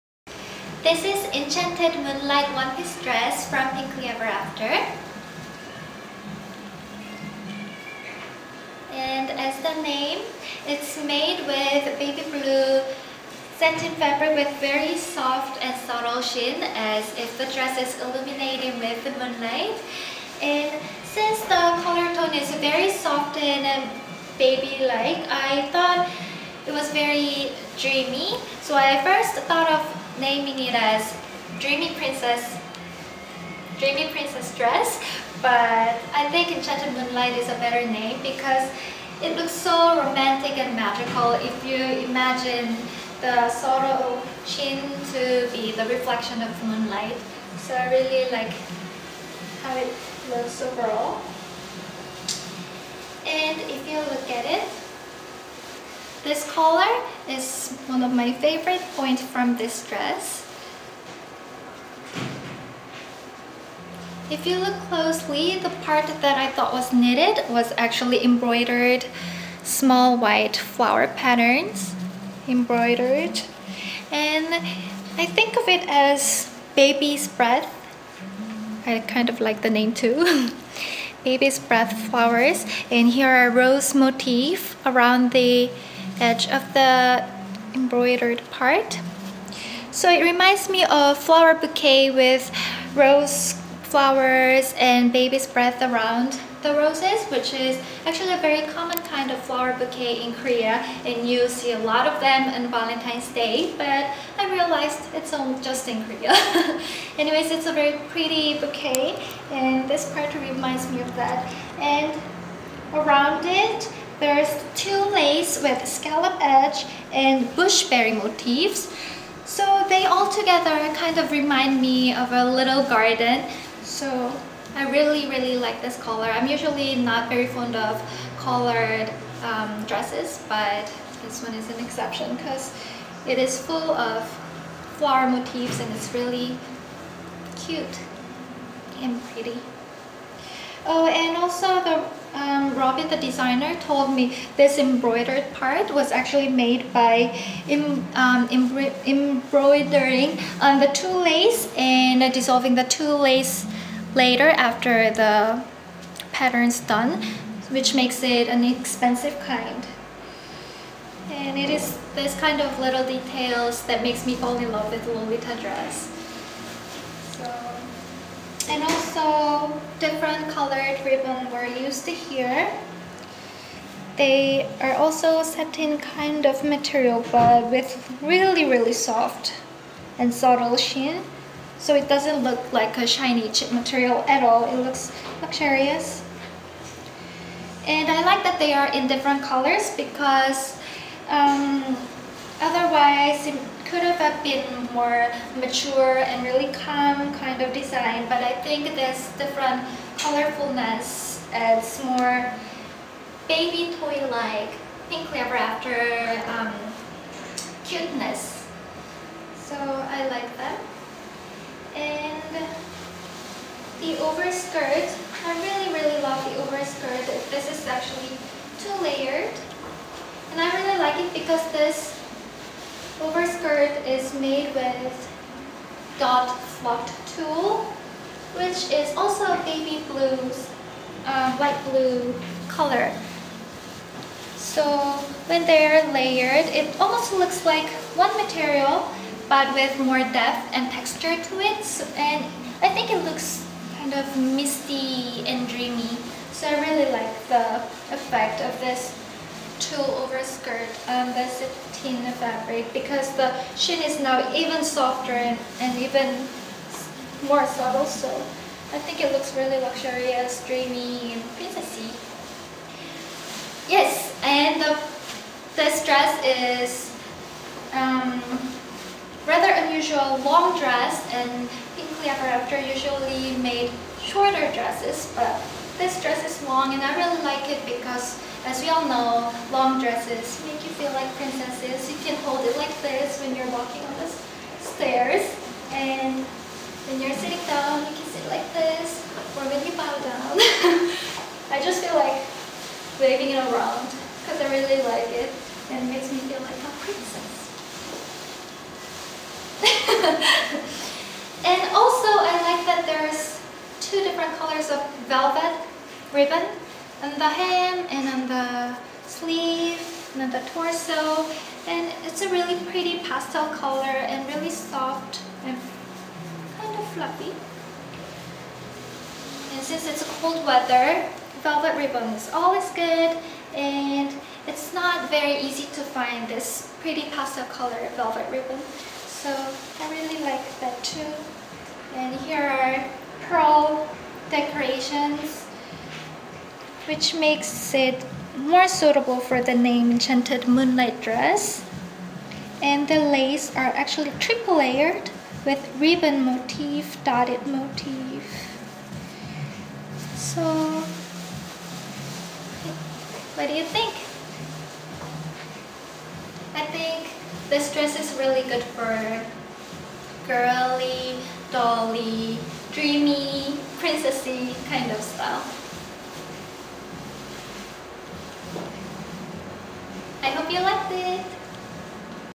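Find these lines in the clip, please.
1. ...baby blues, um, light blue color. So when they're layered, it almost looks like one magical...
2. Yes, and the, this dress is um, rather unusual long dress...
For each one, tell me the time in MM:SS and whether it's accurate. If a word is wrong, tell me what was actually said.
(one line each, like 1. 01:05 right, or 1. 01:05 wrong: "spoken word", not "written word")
1. 03:49 wrong: "material", not "magical"
2. 04:23 right.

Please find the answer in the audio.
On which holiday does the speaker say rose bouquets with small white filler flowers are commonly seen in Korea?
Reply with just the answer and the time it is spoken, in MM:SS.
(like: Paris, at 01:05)
Valentine's Day, at 01:42.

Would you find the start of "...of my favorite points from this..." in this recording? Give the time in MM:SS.
00:58.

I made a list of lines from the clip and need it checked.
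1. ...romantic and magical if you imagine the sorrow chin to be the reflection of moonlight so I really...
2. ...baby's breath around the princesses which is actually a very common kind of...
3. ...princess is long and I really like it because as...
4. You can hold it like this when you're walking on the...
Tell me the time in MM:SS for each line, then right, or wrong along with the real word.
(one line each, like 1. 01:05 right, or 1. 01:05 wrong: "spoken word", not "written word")
1. 00:40 right
2. 01:35 wrong: "roses", not "princesses"
3. 04:36 wrong: "dress", not "princess"
4. 04:42 right.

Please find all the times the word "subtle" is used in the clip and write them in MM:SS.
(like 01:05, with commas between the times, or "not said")
00:15, 03:00, 04:17.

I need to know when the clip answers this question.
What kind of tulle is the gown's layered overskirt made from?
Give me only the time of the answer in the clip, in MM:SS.
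03:46.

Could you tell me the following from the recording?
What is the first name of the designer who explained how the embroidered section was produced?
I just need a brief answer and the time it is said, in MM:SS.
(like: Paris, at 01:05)
Robbie, at 02:22.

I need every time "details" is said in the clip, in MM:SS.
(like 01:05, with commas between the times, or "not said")
02:43.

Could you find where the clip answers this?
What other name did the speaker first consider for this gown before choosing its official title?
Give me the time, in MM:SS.
00:33.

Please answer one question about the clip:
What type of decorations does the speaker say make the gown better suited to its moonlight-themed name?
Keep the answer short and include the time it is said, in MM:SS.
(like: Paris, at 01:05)
pearl decorations, at 05:33.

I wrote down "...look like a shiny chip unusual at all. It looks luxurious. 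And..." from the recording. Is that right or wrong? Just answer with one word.
wrong.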